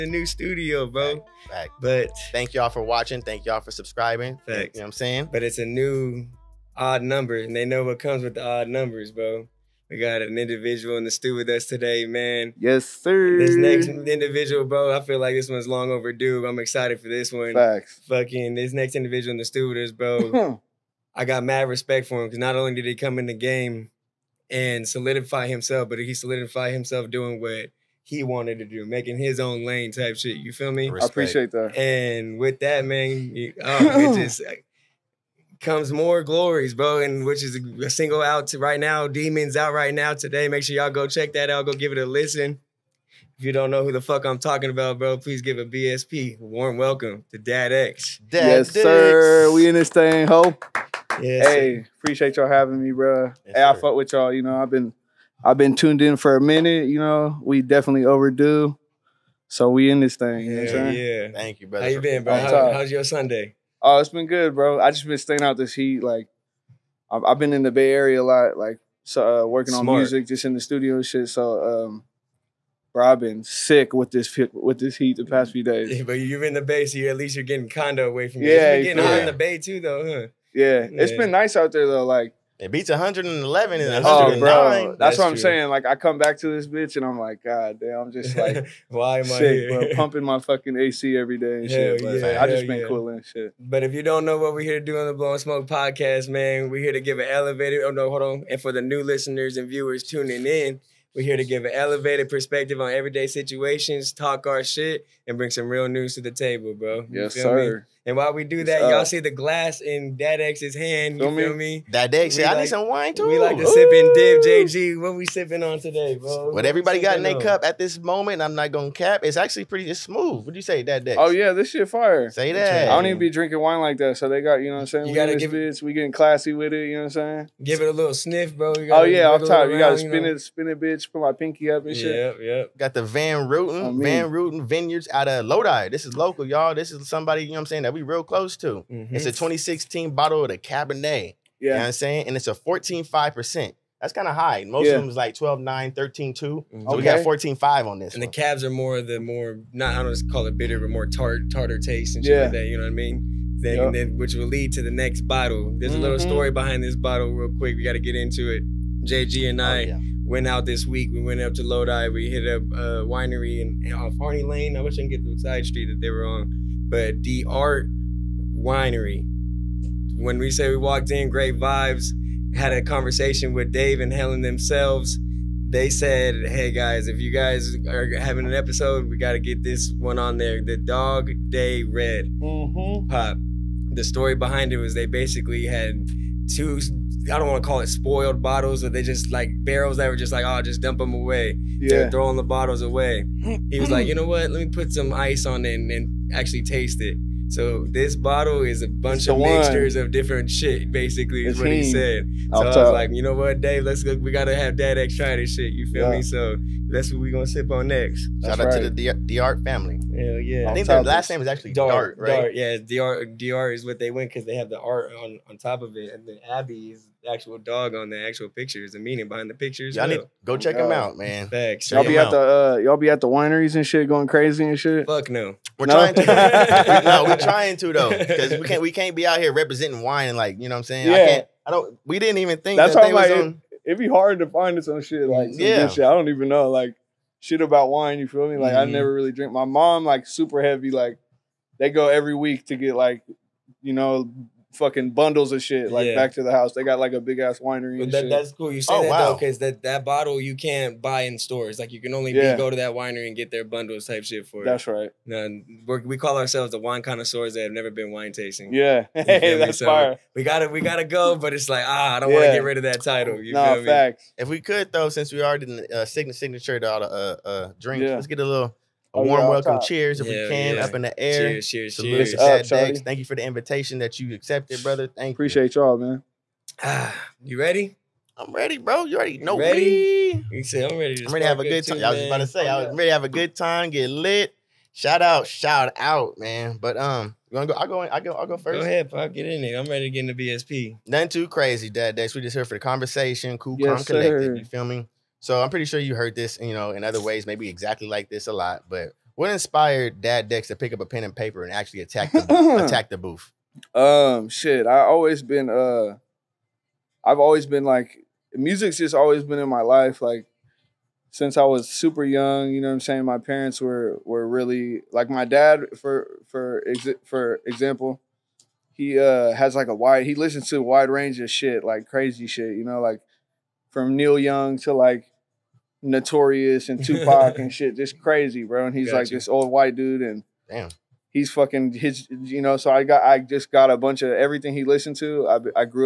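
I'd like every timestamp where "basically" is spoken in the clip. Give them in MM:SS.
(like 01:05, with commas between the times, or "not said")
03:05, 03:20.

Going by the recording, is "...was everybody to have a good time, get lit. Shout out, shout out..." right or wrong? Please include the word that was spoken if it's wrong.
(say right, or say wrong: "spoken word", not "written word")
wrong: "ready", not "everybody".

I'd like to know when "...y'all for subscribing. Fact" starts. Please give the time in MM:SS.
00:03.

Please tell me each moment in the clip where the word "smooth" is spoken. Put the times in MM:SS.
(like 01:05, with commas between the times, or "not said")
01:59.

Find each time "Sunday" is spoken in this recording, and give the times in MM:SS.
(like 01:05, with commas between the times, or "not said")
01:03.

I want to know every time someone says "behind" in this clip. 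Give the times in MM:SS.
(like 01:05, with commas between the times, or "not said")
02:36, 03:04, 03:39.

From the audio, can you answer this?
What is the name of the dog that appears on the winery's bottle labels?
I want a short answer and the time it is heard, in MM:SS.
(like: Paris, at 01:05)
Abby, at 03:36.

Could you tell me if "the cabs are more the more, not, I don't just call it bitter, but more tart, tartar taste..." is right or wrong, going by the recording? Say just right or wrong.
right.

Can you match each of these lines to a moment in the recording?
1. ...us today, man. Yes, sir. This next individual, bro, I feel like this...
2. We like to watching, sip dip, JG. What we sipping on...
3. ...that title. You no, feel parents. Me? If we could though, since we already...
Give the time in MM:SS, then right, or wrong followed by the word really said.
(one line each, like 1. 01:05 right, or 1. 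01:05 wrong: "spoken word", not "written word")
1. 00:11 right
2. 01:53 wrong: "sipping", not "watching"
3. 04:22 wrong: "facts", not "parents".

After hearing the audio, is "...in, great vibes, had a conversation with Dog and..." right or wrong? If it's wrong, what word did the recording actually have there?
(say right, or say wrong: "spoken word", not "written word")
wrong: "Dave", not "Dog".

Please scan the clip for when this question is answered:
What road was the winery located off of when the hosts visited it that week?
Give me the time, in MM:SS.
02:44.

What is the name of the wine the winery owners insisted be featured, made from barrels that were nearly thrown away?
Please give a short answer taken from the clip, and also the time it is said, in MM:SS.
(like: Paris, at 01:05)
Dog Day Red, at 03:00.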